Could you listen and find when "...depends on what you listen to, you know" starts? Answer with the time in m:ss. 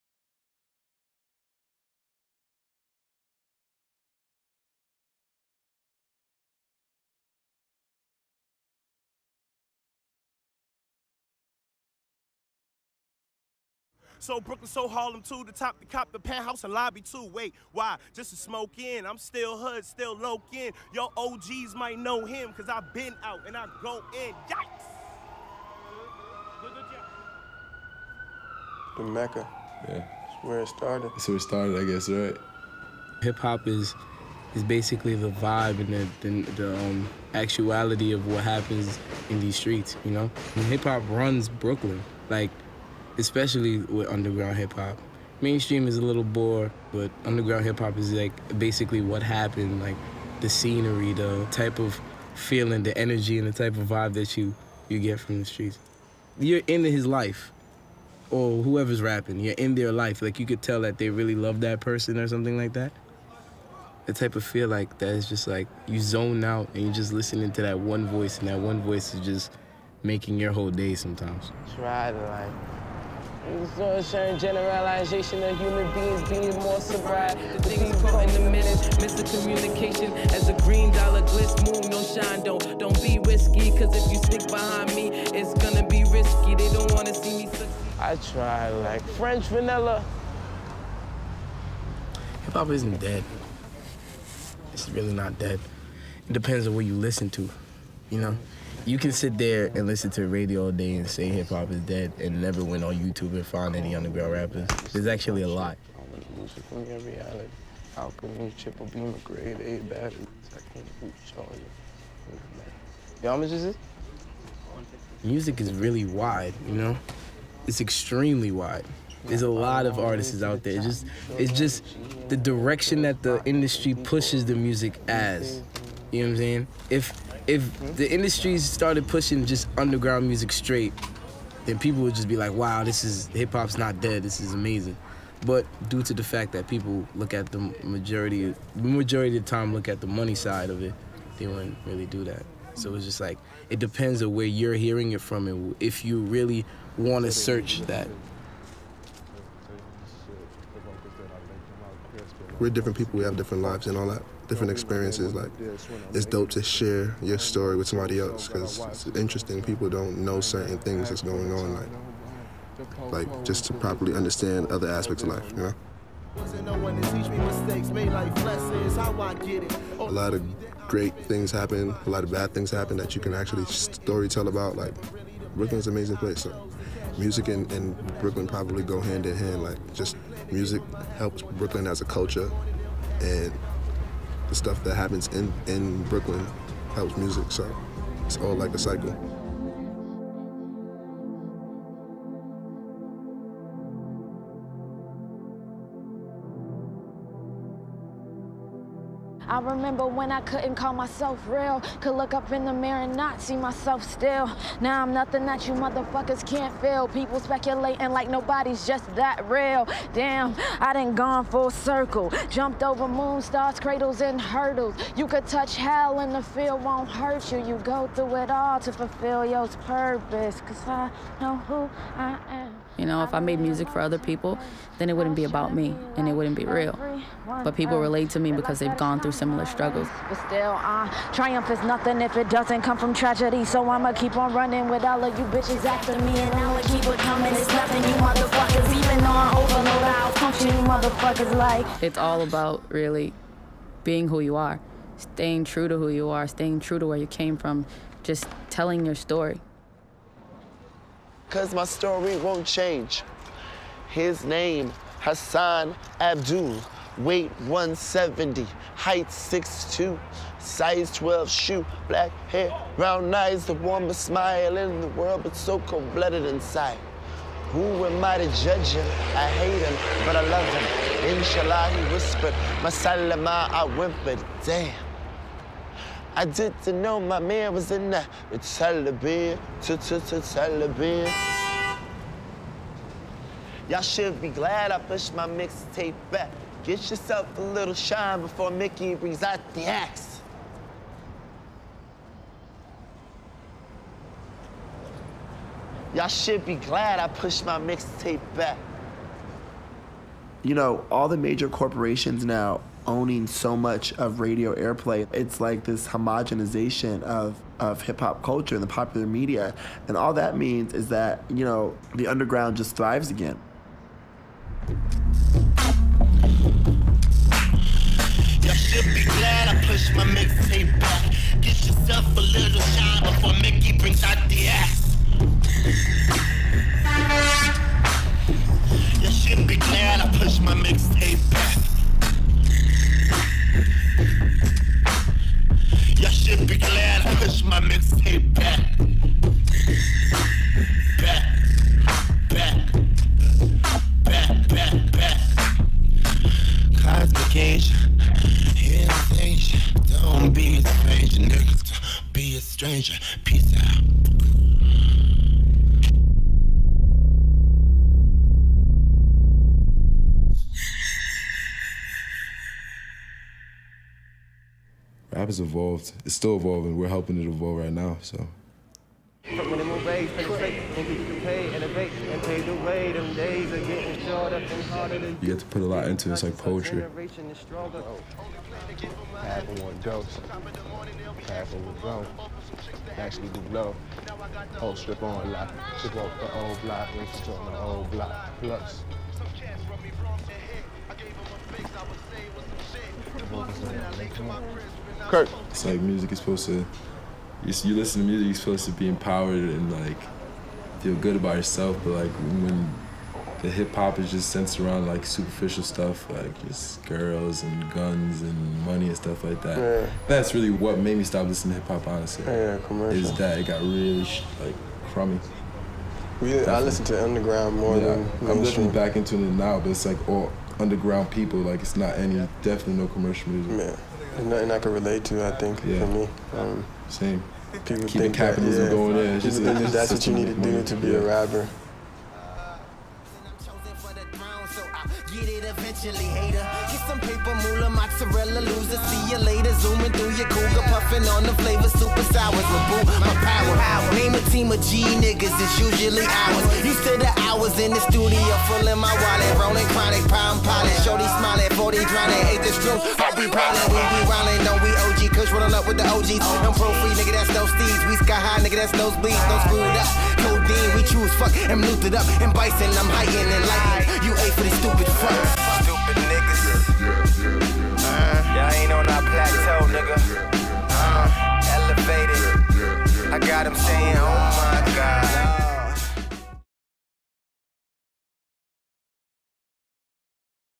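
1:36.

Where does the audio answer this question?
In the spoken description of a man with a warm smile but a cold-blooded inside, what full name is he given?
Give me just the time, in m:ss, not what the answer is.
4:15.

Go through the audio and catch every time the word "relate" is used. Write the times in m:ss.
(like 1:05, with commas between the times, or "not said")
3:47, 7:04.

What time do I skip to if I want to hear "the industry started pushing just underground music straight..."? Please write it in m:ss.
2:07.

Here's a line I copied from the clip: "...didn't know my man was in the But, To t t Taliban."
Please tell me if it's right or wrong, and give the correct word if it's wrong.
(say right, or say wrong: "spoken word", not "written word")
wrong: "Taliban", not "But".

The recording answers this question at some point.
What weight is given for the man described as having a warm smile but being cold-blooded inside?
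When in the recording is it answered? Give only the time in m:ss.
4:17.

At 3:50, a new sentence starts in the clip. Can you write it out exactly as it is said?
But still, uh, triumph is nothing if it doesn't come from tragedy.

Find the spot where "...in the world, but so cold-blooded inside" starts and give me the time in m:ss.
4:24.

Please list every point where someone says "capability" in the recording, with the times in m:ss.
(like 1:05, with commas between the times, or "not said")
not said.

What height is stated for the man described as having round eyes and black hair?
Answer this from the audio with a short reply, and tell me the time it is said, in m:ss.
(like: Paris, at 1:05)
6'2, at 4:19.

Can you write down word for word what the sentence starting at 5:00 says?
You know, all the major corporations now owning so much of radio airplay.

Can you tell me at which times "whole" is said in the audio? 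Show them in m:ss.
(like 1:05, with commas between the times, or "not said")
1:10, 6:24.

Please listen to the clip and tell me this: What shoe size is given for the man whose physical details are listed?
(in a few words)
12.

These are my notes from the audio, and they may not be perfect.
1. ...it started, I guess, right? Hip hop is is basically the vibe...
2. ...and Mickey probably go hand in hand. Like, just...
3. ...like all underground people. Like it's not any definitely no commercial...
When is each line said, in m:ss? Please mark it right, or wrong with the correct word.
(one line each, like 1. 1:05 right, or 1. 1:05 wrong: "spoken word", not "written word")
1. 0:31 right
2. 2:57 wrong: "Brooklyn", not "Mickey"
3. 7:00 right.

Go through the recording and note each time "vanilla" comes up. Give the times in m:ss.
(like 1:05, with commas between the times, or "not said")
1:29.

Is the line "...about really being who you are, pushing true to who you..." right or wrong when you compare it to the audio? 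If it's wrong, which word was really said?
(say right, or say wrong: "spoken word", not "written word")
wrong: "staying", not "pushing".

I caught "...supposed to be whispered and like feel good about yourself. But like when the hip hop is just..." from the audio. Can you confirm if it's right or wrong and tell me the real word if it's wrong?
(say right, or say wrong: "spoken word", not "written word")
wrong: "empowered", not "whispered".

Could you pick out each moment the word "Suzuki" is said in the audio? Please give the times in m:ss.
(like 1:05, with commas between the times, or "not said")
not said.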